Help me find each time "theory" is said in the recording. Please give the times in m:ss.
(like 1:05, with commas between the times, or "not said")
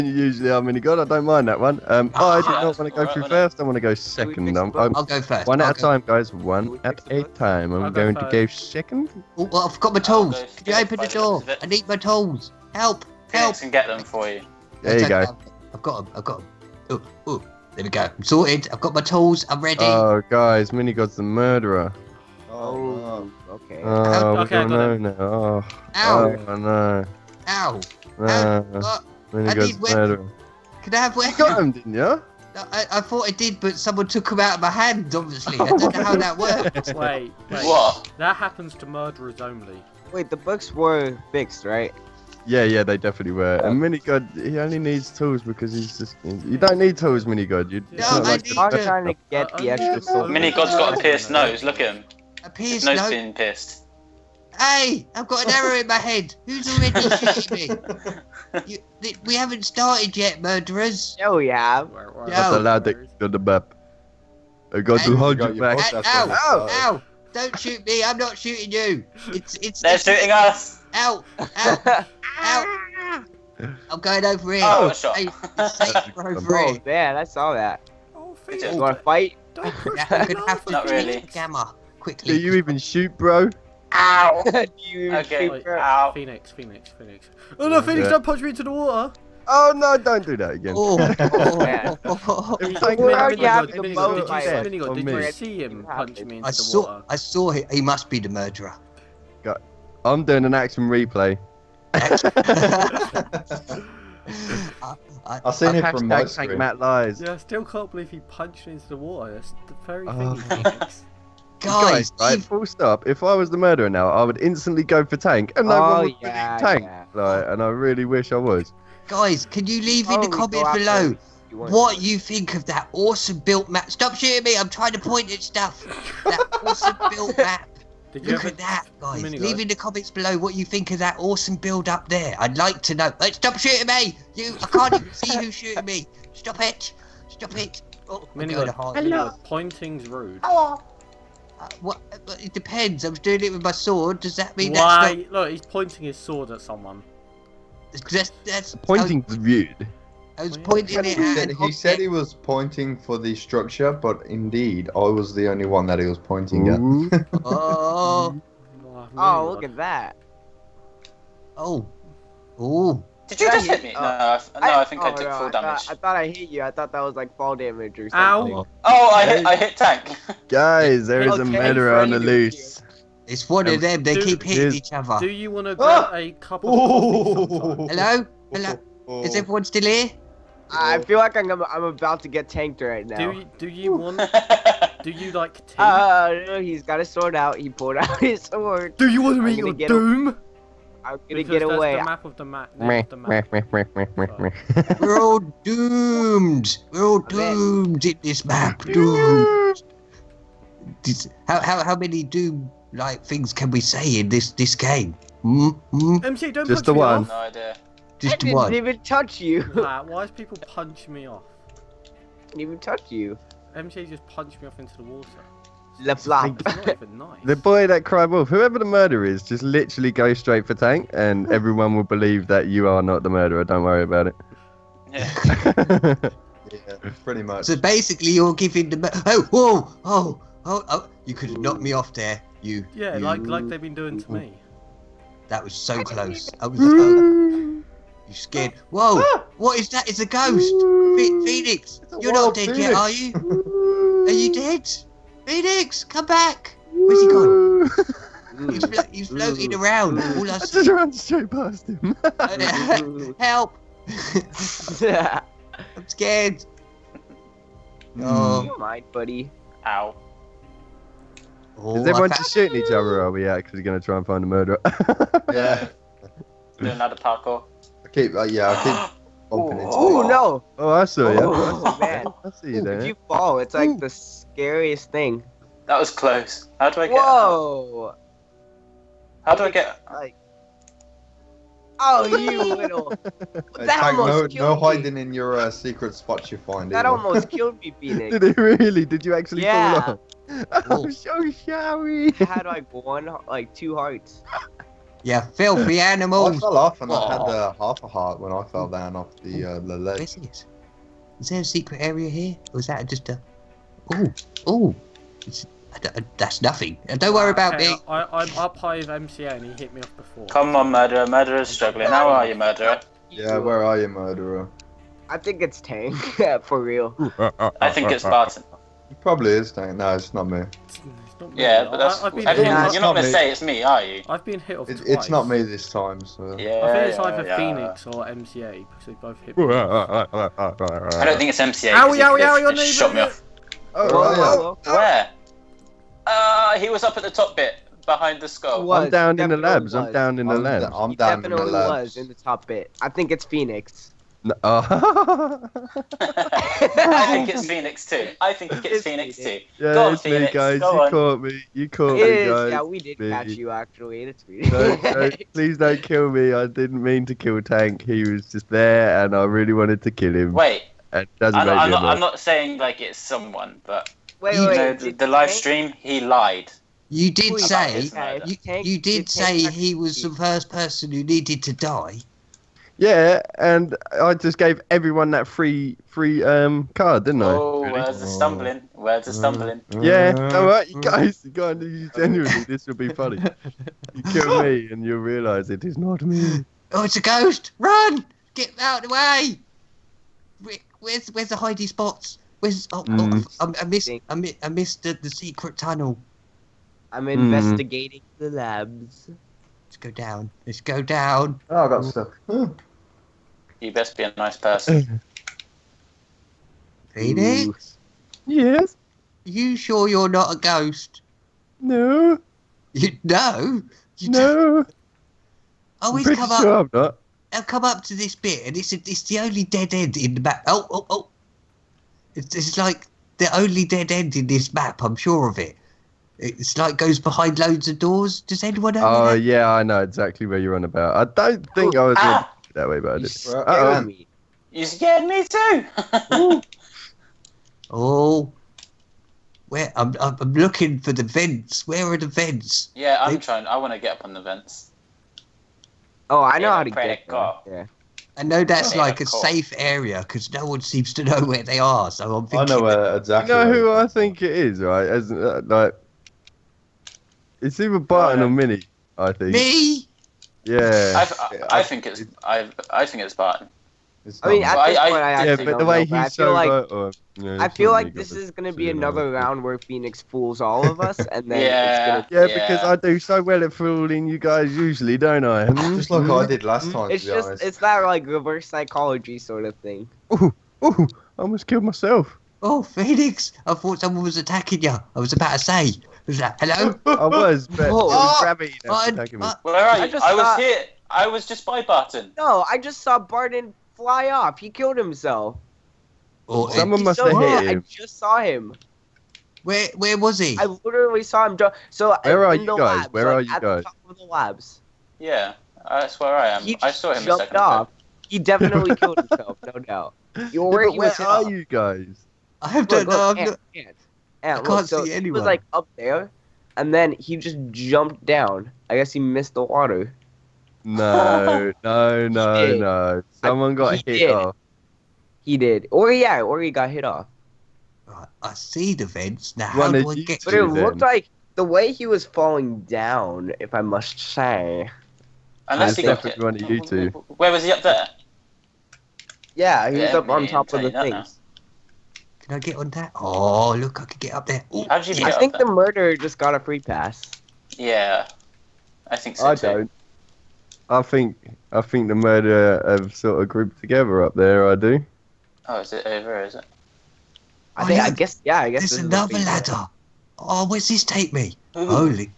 not said.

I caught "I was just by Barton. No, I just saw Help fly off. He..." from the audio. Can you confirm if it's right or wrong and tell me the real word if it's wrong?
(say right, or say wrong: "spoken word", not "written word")
wrong: "Barton", not "Help".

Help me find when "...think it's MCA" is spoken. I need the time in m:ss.
5:31.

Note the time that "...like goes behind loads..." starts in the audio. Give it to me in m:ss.
7:06.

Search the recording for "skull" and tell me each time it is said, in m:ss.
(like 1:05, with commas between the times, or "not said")
5:38.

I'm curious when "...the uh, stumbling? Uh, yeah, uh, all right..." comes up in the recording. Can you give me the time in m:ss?
6:19.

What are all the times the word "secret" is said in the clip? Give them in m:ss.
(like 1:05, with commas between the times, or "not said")
4:45, 5:01, 6:35.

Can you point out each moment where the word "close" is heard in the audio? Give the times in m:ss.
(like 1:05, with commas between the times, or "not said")
3:56, 4:36.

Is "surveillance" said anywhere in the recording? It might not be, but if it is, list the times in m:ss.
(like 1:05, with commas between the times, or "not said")
not said.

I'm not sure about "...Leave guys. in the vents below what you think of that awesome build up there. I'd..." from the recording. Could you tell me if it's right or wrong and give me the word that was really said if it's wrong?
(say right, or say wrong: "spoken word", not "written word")
wrong: "comments", not "vents".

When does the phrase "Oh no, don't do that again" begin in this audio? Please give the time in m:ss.
1:29.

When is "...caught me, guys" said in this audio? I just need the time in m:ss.
5:51.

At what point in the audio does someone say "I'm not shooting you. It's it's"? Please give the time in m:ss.
1:08.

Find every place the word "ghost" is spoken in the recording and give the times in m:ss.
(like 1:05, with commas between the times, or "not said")
4:00, 6:27, 6:50.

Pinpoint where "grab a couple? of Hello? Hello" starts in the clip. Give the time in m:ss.
2:56.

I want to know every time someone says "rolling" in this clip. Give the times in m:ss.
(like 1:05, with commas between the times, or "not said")
not said.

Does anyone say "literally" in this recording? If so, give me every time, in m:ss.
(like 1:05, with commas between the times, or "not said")
3:39, 8:20.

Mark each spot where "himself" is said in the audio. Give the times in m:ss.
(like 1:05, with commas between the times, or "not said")
8:14, 8:29.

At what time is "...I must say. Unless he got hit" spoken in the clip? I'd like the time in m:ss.
8:53.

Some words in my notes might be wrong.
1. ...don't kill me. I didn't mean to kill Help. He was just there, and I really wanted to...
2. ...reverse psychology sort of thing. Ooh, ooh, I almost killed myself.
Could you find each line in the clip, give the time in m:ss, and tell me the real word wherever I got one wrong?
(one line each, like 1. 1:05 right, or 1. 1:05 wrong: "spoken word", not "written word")
1. 5:55 wrong: "Tank", not "Help"
2. 7:58 right.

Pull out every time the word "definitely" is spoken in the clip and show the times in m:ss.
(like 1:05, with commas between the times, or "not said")
0:42, 8:28.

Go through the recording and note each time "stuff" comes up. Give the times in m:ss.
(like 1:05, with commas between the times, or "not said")
2:05.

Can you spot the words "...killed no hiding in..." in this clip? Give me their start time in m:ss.
4:44.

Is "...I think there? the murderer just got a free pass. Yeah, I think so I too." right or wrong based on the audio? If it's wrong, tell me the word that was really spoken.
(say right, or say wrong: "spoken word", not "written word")
right.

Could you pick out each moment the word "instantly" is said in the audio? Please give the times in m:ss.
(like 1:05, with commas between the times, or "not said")
1:54.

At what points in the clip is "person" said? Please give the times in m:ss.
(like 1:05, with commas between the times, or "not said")
6:10, 6:44.